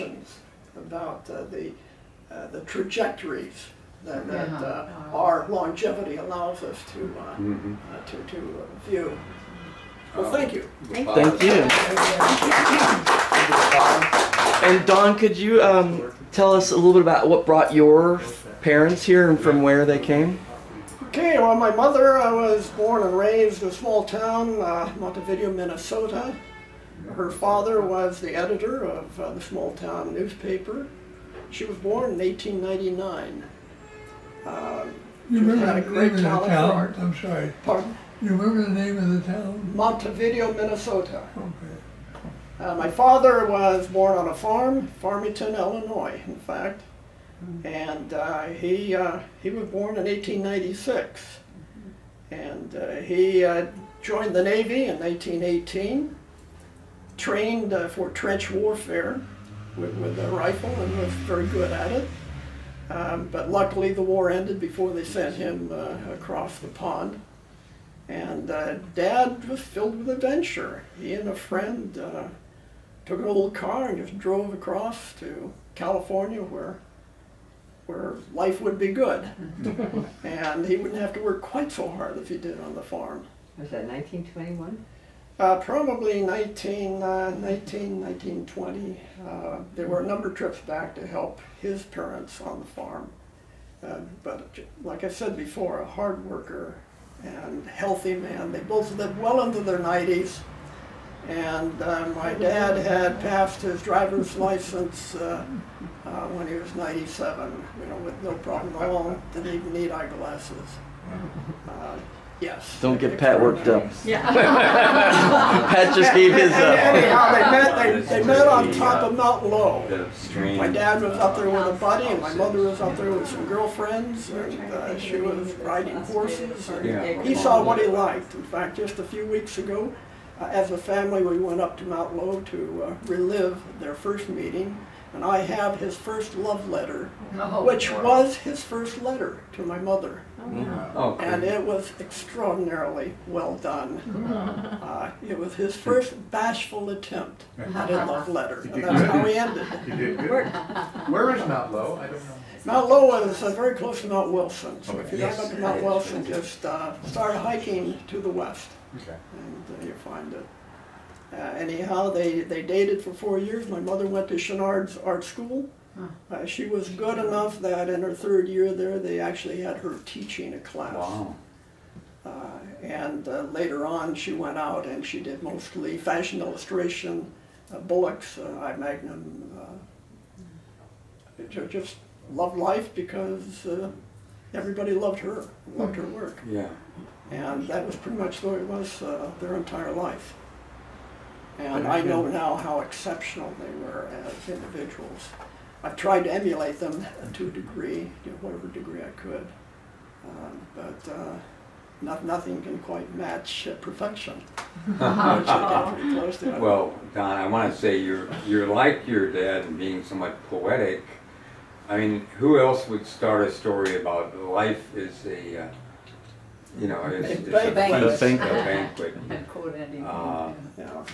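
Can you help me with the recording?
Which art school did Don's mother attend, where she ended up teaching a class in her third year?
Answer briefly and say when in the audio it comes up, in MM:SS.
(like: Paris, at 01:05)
Chouinard's art school, at 02:44.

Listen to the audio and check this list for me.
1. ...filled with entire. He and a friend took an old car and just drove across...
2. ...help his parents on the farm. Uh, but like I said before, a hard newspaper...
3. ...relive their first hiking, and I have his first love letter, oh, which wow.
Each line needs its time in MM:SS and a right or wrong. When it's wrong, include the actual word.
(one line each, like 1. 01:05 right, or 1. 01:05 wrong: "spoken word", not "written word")
1. 01:09 wrong: "adventure", not "entire"
2. 01:31 wrong: "worker", not "newspaper"
3. 02:13 wrong: "meeting", not "hiking".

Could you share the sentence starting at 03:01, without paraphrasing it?
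just loved life because everybody loved her, loved her work.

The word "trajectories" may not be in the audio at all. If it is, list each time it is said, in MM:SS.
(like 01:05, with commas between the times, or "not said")
00:02.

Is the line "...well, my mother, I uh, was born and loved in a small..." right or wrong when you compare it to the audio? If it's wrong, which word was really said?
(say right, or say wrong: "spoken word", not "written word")
wrong: "raised", not "loved".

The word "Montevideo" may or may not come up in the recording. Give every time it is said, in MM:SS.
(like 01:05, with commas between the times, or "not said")
00:24, 00:39.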